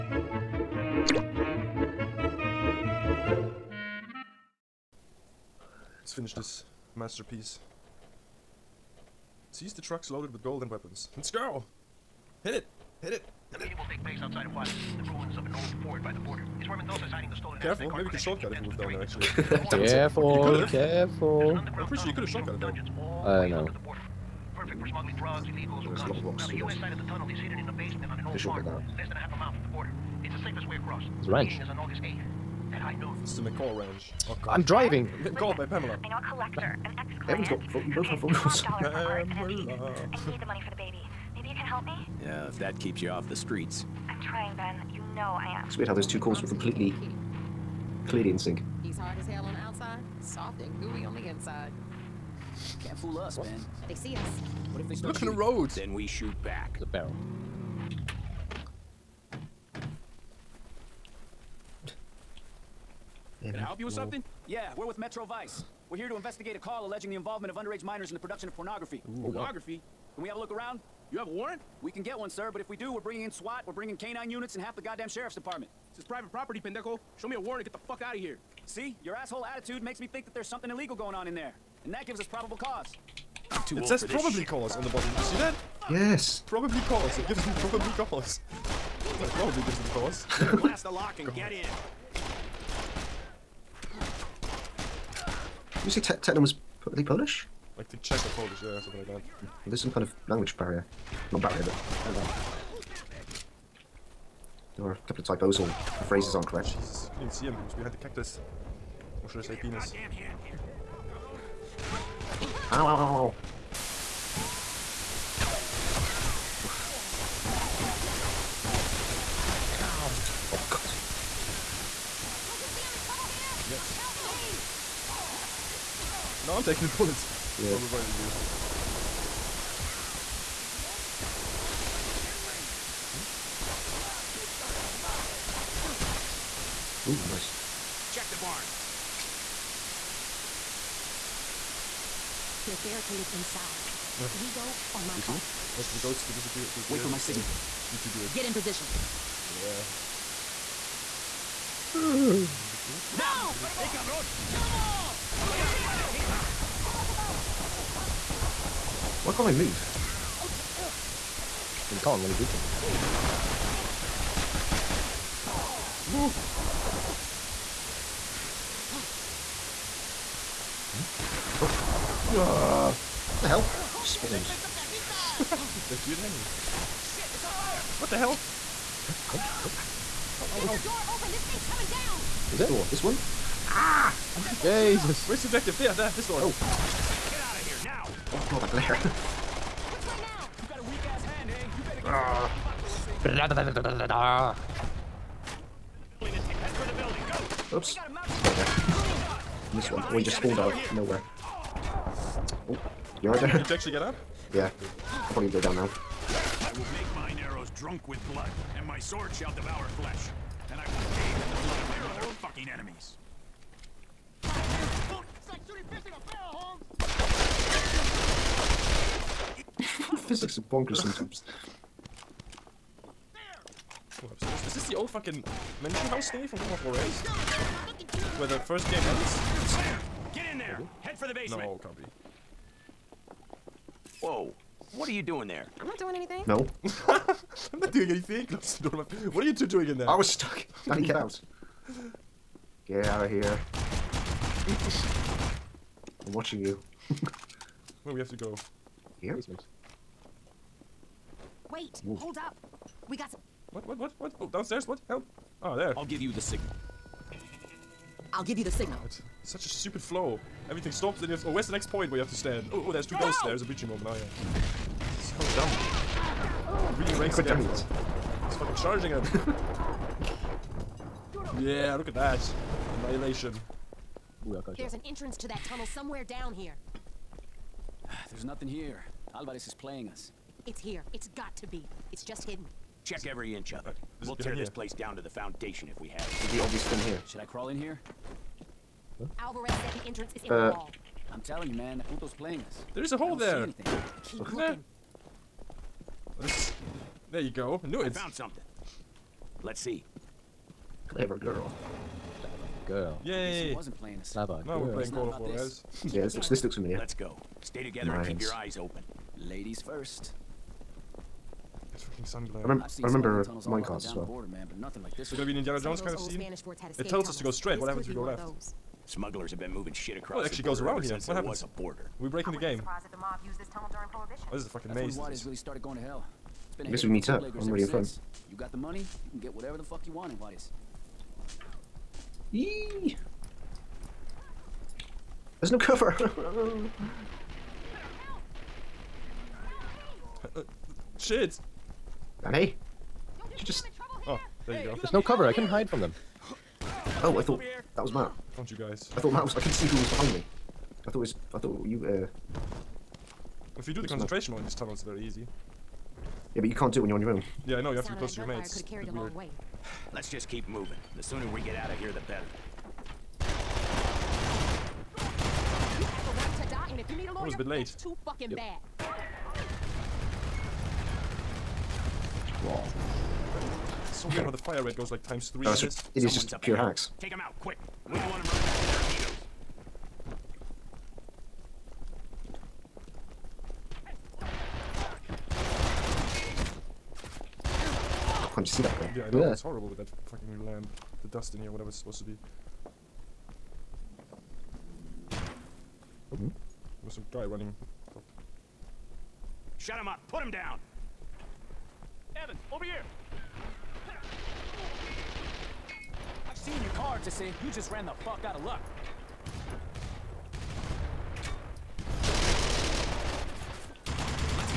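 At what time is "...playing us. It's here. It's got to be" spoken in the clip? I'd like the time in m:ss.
4:39.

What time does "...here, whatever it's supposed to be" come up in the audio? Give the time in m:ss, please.
6:31.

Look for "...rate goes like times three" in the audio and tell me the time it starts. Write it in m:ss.
6:14.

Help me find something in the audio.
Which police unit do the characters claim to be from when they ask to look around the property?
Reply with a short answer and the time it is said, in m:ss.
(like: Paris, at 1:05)
Metro Vice, at 1:04.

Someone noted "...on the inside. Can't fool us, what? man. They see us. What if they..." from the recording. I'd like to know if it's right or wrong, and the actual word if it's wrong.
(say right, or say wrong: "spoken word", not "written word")
right.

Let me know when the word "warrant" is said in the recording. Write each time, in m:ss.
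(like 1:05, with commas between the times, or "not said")
1:11, 1:17.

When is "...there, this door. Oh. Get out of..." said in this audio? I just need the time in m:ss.
3:05.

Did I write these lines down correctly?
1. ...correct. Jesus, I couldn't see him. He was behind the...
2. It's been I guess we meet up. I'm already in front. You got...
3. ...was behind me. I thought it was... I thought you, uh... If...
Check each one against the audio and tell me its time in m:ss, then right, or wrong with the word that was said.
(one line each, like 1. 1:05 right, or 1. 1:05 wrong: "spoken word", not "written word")
1. 1:46 right
2. 5:26 right
3. 5:49 right.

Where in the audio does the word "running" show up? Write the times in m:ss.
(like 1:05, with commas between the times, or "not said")
6:18, 6:37.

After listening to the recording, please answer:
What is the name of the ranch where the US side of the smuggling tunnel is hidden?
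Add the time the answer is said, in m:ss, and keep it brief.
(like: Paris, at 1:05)
McCall Ranch, at 0:33.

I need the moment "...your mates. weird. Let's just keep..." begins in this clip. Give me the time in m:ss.
5:58.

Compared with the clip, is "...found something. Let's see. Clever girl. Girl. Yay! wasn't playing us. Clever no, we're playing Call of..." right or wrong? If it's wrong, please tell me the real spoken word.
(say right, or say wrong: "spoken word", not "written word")
right.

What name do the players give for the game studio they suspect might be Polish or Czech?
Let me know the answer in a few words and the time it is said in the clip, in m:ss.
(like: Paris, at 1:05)
Techland, at 1:36.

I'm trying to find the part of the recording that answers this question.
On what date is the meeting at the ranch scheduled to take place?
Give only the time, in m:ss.
0:31.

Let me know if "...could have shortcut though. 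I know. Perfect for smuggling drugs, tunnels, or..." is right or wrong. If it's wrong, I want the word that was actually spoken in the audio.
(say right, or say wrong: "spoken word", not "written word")
wrong: "illegals", not "tunnels".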